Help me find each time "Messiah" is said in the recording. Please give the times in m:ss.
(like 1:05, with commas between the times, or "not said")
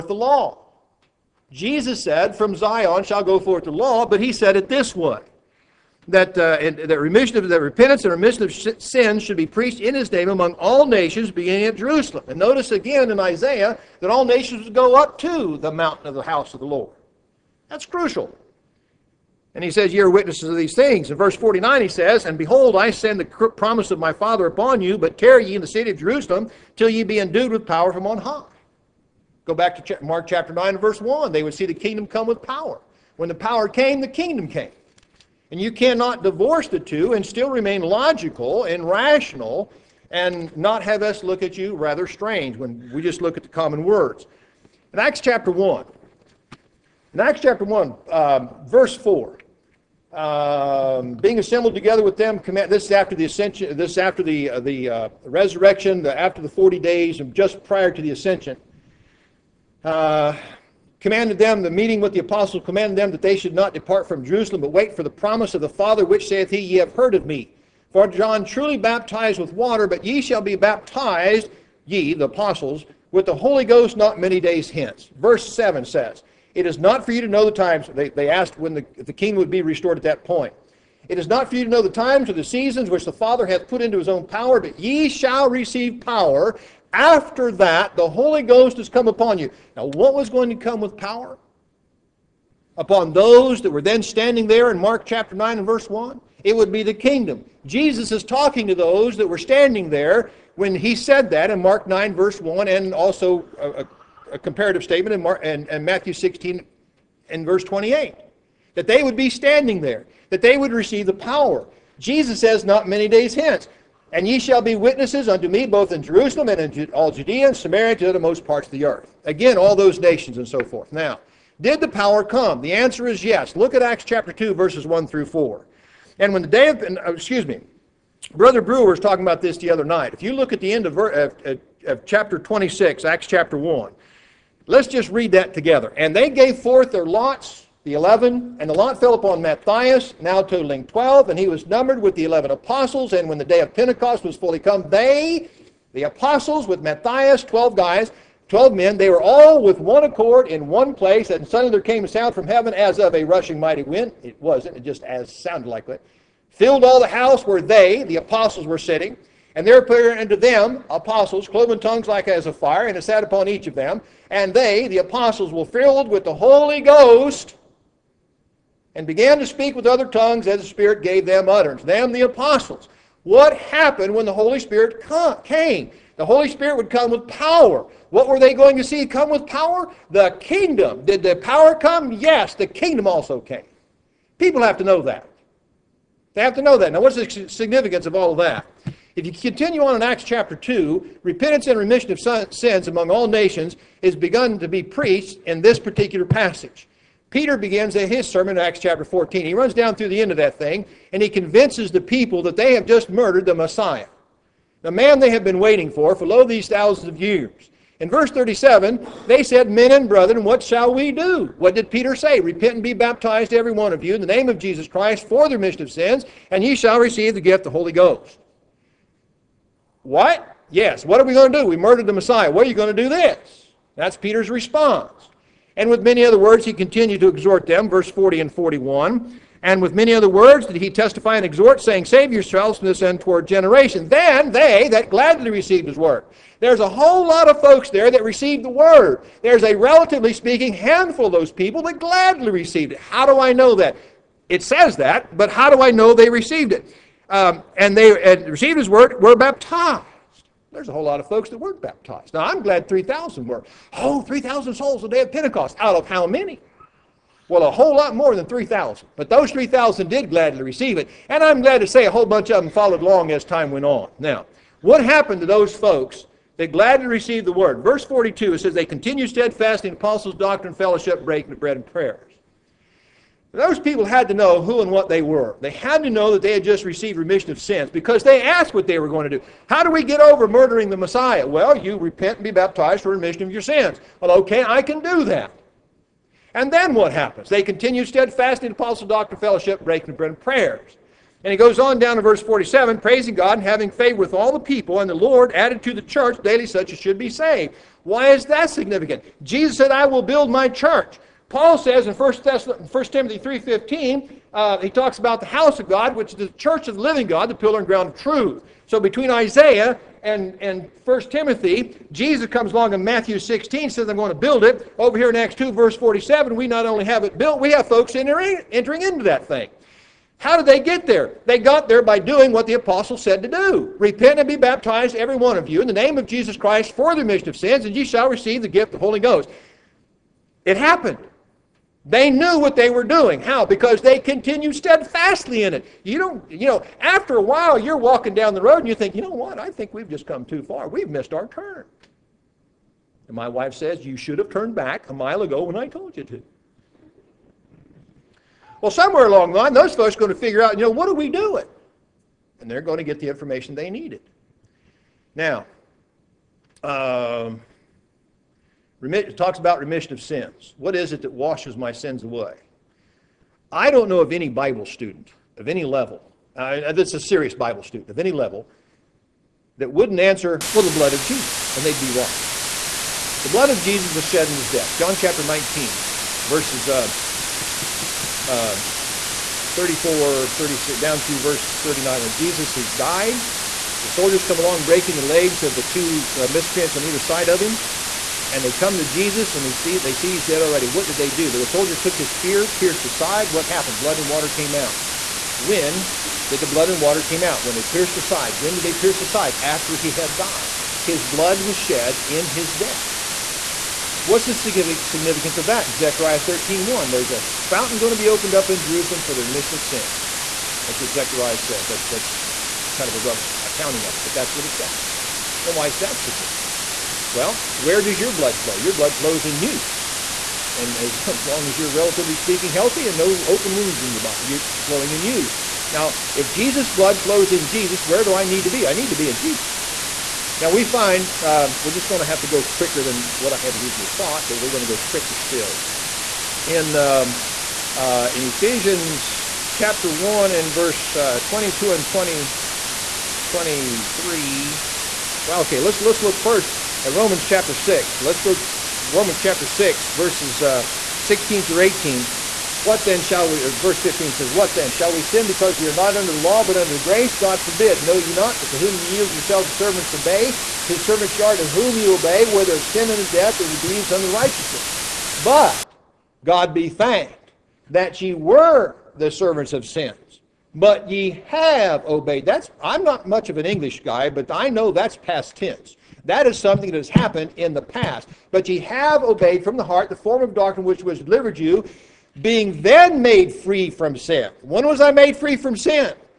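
3:23, 3:42, 4:40.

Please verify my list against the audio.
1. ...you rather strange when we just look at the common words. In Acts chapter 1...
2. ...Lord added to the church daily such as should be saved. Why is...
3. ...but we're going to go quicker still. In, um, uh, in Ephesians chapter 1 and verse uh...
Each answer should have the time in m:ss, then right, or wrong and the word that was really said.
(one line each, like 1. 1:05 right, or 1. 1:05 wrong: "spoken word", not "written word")
1. 0:41 right
2. 4:55 right
3. 7:14 right.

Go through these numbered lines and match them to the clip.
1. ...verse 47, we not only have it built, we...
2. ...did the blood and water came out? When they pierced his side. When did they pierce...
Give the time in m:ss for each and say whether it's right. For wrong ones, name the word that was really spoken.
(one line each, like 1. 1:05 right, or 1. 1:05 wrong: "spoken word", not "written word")
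1. 5:15 right
2. 6:36 right.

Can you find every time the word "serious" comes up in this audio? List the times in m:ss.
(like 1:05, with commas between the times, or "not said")
6:07.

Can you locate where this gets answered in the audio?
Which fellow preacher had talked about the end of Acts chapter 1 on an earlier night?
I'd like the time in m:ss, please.
2:08.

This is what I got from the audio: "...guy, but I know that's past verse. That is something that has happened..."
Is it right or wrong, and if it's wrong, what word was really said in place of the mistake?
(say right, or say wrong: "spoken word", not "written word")
wrong: "tense", not "verse".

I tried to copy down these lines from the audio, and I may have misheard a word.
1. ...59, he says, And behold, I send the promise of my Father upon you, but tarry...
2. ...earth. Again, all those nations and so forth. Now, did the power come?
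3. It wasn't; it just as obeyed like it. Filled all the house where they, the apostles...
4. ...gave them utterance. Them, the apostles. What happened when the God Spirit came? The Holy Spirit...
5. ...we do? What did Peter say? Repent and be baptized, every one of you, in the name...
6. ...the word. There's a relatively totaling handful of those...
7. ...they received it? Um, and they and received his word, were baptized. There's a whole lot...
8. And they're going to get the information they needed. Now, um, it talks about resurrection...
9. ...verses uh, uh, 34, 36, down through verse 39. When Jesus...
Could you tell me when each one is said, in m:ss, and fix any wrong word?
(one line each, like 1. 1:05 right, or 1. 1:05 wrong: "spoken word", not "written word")
1. 0:21 wrong: "49", not "59"
2. 1:58 right
3. 2:34 wrong: "sounded", not "obeyed"
4. 2:51 wrong: "Holy", not "God"
5. 3:30 right
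6. 3:58 wrong: "speaking", not "totaling"
7. 4:06 right
8. 5:52 wrong: "remission", not "resurrection"
9. 6:16 right.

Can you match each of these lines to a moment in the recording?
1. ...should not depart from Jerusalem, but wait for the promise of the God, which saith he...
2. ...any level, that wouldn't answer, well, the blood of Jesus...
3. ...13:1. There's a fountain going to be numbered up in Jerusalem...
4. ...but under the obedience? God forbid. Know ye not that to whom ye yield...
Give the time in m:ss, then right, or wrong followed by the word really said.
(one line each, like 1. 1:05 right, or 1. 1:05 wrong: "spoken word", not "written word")
1. 1:03 wrong: "Father", not "God"
2. 6:08 right
3. 6:46 wrong: "opened", not "numbered"
4. 7:36 wrong: "grace", not "obedience".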